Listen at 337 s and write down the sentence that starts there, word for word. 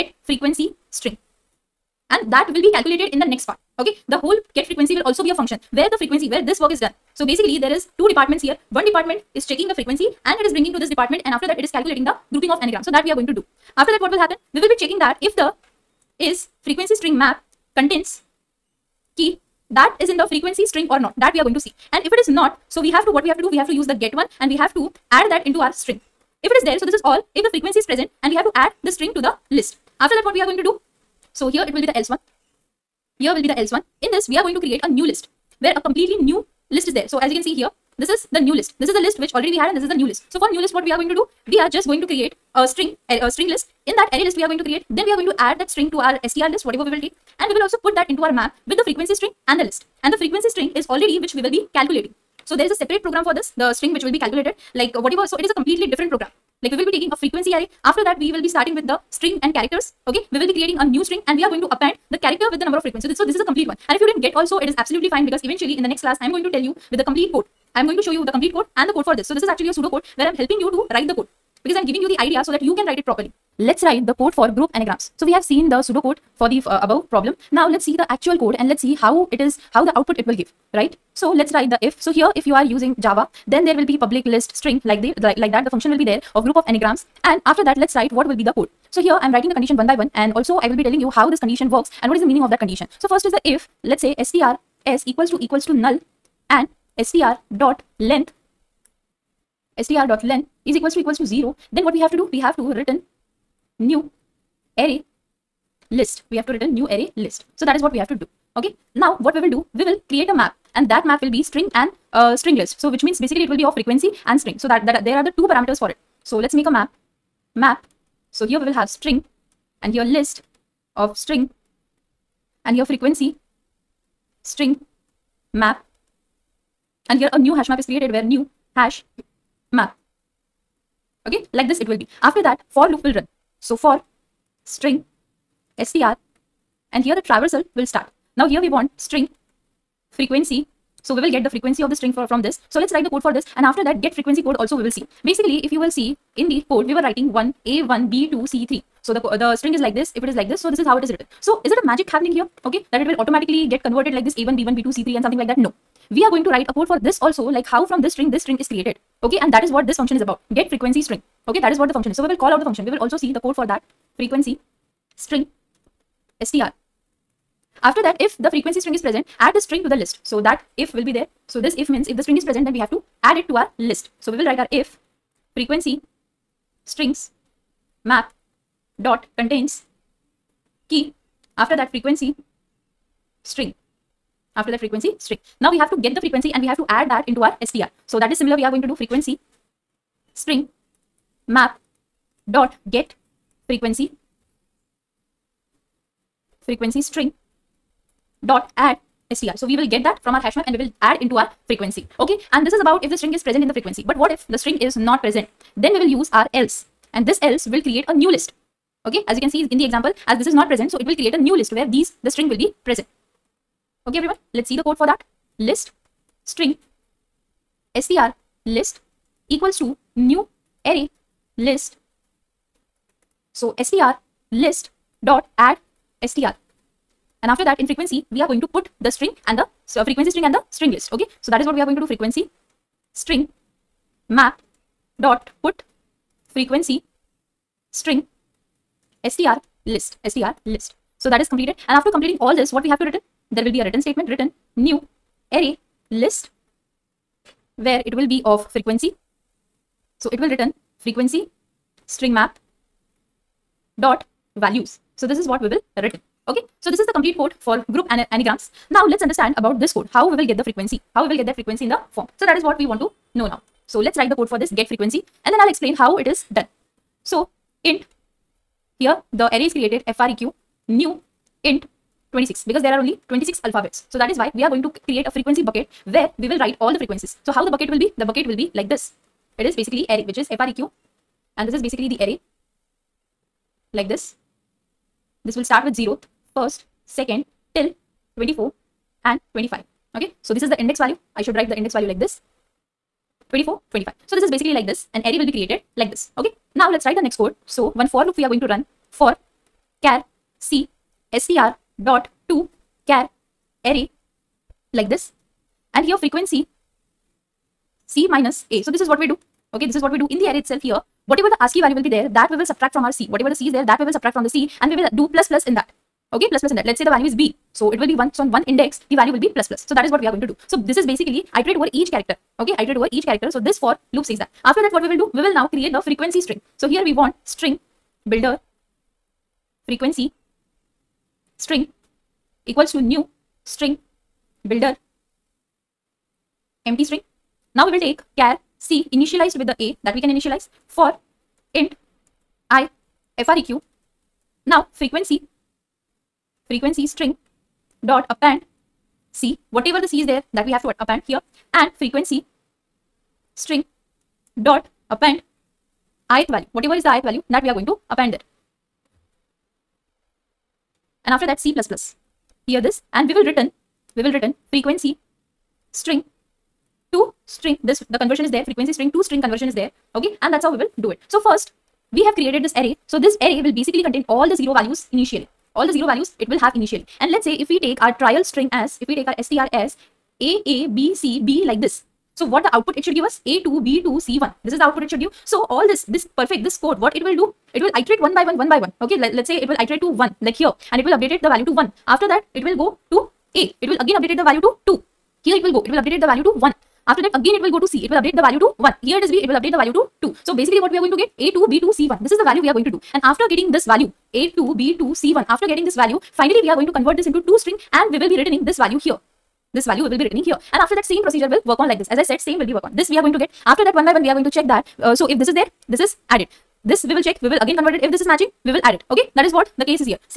Now we will take care C initialized with the A that we can initialize for int I FREQ.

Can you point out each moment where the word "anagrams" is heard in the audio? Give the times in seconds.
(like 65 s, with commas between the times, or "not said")
12 s, 74 s, 86 s, 258 s.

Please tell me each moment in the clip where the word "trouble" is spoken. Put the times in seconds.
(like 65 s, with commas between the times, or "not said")
not said.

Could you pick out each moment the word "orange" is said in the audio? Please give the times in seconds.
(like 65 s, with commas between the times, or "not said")
not said.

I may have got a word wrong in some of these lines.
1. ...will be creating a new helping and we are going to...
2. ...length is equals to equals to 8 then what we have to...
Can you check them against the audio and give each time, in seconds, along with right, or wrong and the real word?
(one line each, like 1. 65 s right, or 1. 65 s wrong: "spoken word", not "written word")
1. 60 s wrong: "string", not "helping"
2. 100 s wrong: "0", not "8".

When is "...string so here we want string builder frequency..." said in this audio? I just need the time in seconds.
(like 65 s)
326 s.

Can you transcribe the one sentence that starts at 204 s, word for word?
But what if the string is not present?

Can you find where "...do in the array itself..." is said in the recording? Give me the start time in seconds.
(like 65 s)
310 s.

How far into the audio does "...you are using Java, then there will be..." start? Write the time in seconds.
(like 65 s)
82 s.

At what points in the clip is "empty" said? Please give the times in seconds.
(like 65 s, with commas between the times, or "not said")
336 s.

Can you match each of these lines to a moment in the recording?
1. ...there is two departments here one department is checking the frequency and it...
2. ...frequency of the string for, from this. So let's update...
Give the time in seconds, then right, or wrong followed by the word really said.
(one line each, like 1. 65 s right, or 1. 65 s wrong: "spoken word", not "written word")
1. 7 s right
2. 141 s wrong: "write", not "update".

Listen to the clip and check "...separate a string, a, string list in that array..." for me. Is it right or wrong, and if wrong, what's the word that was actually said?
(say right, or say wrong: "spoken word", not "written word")
wrong: "create", not "separate".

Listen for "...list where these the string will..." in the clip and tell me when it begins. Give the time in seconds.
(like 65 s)
211 s.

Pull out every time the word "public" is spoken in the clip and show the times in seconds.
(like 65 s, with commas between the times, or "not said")
84 s.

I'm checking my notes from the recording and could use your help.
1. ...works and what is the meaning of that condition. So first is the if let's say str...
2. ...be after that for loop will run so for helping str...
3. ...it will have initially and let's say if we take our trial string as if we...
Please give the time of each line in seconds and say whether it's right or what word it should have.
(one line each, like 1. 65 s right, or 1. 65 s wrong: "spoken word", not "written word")
1. 91 s right
2. 131 s wrong: "string", not "helping"
3. 376 s right.